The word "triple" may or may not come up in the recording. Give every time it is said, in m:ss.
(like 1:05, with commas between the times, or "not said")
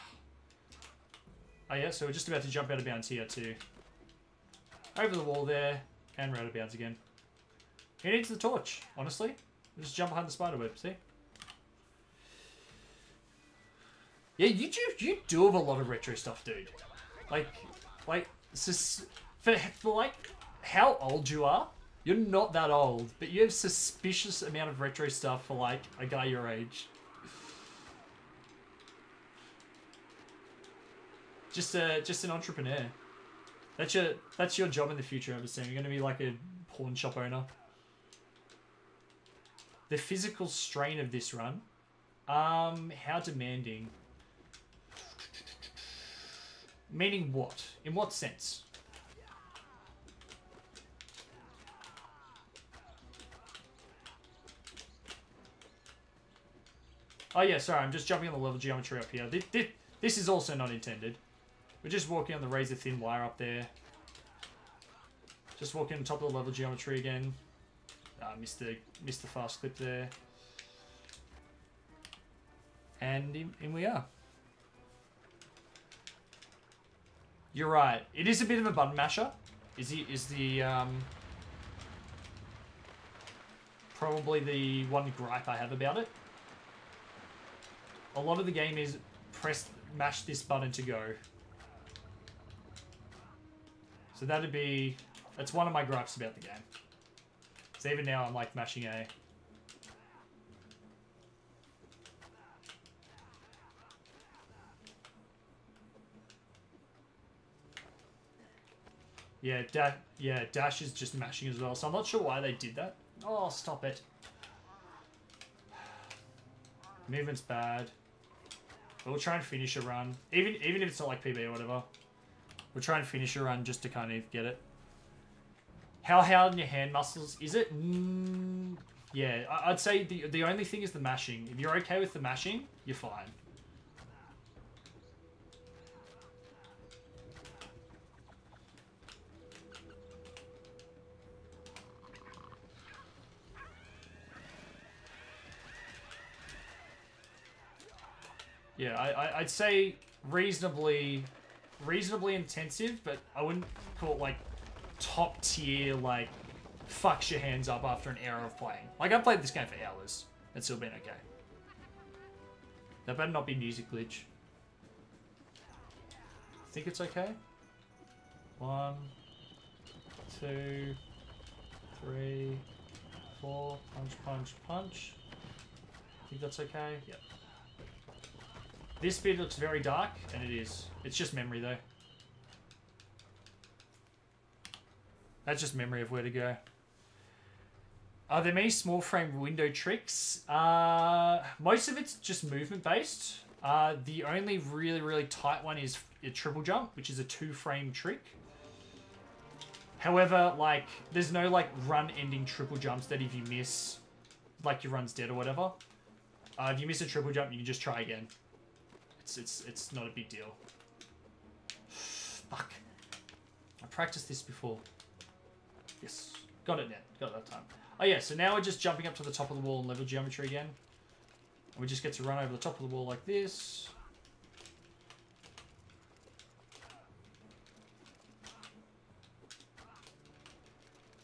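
3:16, 3:22, 3:27.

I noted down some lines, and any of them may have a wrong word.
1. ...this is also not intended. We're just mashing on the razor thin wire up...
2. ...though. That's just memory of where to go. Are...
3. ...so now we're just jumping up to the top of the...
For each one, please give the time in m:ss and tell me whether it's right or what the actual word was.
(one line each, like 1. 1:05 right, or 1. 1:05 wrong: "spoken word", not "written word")
1. 1:00 wrong: "walking", not "mashing"
2. 3:01 right
3. 3:38 right.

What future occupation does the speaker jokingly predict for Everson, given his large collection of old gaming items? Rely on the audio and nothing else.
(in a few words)
Pawn shop owner.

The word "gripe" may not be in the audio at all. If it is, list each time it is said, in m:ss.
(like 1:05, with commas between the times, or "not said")
1:25, 1:35.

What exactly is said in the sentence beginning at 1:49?
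Yeah, da yeah, Dash is just mashing as well, so I'm not sure why they did that.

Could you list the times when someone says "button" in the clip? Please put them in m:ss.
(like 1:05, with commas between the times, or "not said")
1:18, 1:30.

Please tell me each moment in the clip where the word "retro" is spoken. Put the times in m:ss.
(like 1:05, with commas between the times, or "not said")
0:15, 0:24.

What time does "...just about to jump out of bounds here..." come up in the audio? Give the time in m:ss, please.
0:02.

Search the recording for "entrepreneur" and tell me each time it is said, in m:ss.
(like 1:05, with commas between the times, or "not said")
0:32.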